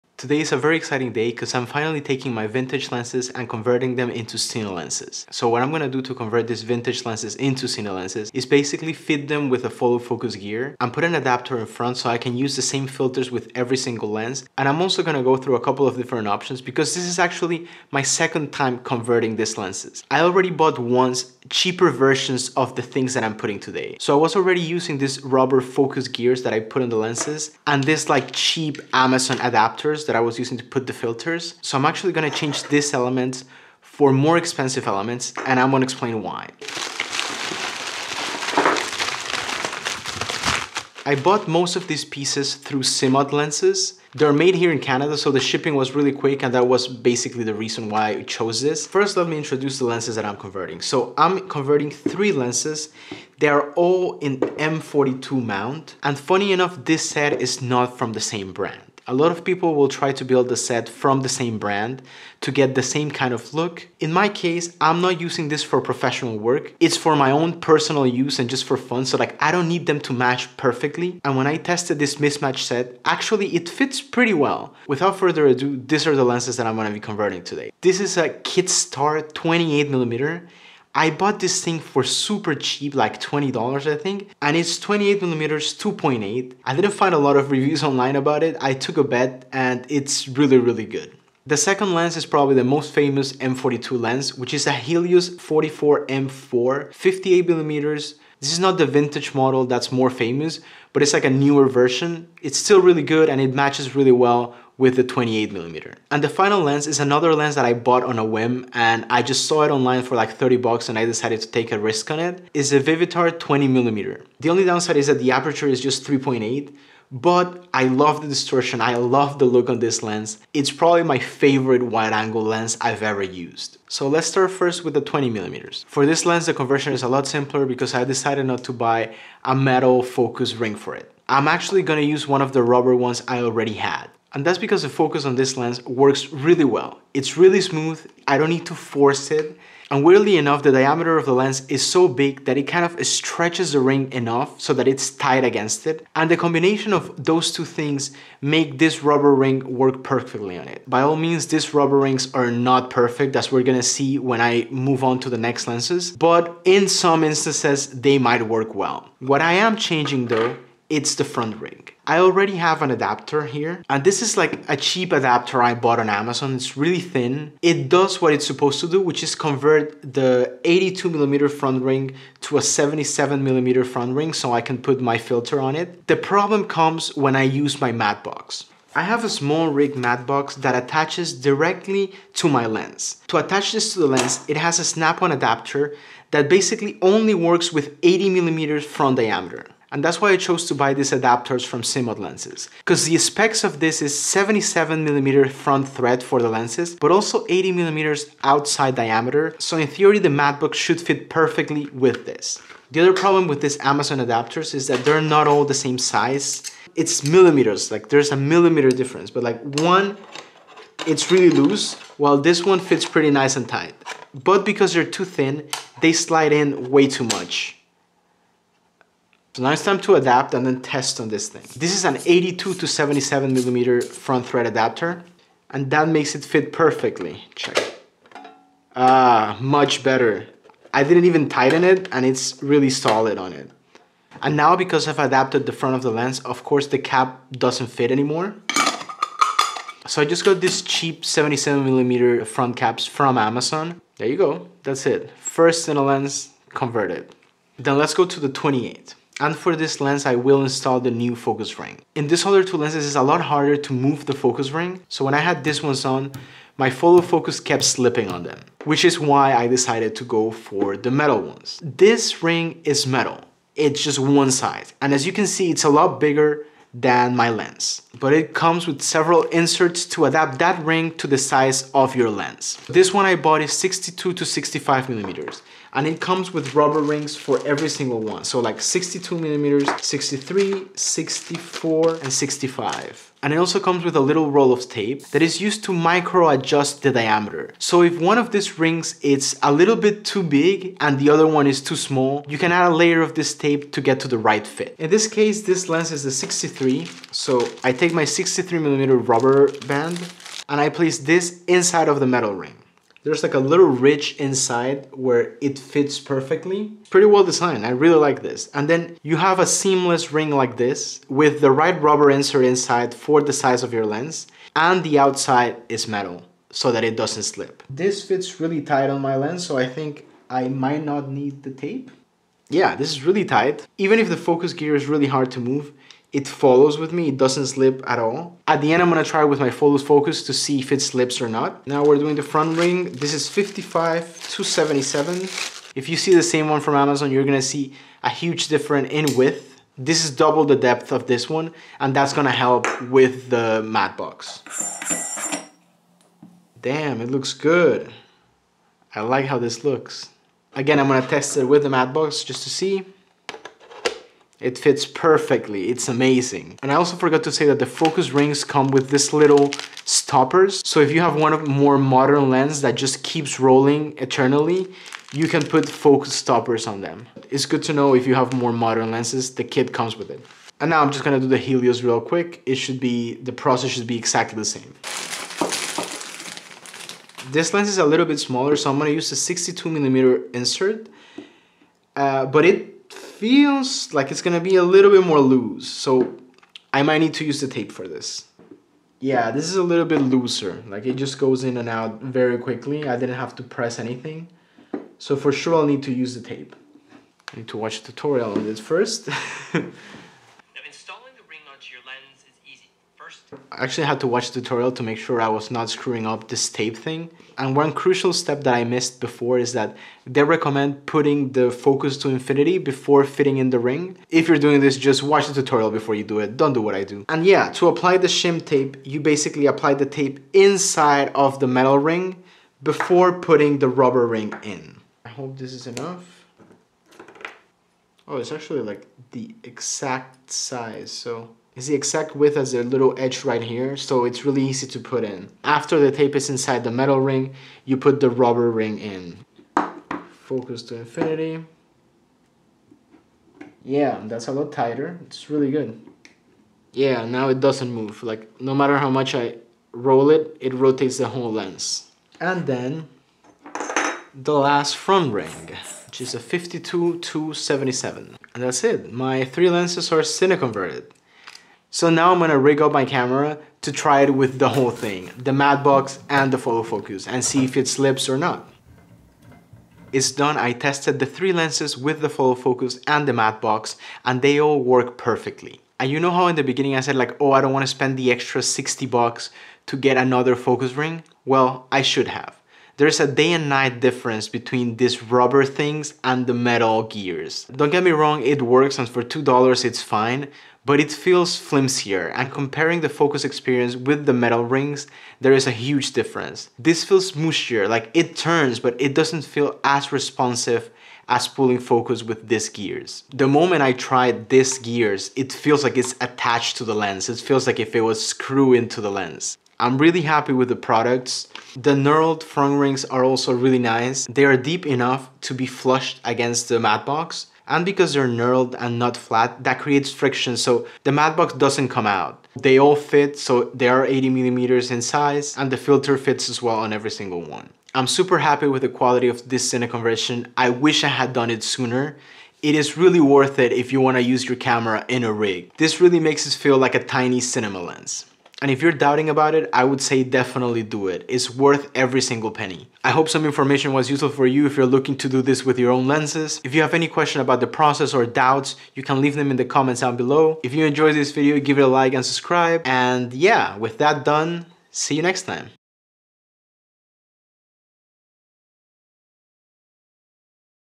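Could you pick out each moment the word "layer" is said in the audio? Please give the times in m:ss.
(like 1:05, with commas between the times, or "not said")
4:52.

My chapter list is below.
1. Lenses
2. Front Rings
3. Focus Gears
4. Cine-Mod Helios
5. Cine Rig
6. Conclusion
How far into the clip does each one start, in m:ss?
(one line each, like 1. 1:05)
1. 0:49
2. 2:04
3. 4:09
4. 6:10
5. 7:42
6. 8:48.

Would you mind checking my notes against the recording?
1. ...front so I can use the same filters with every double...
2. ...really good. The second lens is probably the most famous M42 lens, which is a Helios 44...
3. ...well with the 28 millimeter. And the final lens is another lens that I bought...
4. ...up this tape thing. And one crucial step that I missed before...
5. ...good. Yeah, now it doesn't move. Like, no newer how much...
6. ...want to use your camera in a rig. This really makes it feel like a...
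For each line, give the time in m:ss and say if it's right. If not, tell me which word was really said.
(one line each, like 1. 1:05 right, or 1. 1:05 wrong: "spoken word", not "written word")
1. 0:11 wrong: "single", not "double"
2. 1:30 right
3. 1:44 right
4. 6:46 right
5. 7:25 wrong: "matter", not "newer"
6. 8:54 right.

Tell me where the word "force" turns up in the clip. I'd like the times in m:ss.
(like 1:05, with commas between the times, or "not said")
2:18.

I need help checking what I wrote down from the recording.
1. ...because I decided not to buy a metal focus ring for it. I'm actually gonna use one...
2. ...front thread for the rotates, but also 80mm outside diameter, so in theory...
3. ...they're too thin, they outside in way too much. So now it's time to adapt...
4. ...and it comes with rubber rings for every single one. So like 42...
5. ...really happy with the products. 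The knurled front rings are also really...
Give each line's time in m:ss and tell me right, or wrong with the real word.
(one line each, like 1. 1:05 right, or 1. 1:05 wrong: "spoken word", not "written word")
1. 2:07 right
2. 3:15 wrong: "lenses", not "rotates"
3. 3:34 wrong: "slide", not "outside"
4. 4:35 wrong: "62", not "42"
5. 8:29 right.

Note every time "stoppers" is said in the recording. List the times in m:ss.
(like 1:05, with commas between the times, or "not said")
6:00, 6:06.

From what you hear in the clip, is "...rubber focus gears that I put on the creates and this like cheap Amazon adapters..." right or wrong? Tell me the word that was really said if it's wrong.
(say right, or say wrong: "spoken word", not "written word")
wrong: "lenses", not "creates".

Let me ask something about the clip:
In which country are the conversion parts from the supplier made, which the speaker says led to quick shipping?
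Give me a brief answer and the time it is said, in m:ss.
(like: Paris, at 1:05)
Canada, at 0:44.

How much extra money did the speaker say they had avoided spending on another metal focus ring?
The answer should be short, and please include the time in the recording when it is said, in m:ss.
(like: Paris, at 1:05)
60 bucks, at 7:58.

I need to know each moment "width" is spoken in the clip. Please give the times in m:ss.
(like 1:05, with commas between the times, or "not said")
5:39, 7:12.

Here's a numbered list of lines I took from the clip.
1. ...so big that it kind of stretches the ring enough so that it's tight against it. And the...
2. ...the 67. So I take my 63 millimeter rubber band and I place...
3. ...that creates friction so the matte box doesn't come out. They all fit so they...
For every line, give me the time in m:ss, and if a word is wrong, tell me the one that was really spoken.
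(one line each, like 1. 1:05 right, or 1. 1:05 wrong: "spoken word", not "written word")
1. 2:21 right
2. 4:56 wrong: "63", not "67"
3. 8:39 right.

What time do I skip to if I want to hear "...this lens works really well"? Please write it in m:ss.
2:15.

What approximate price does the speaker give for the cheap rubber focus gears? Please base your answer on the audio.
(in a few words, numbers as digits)
$2.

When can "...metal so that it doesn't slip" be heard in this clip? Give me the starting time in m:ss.
5:16.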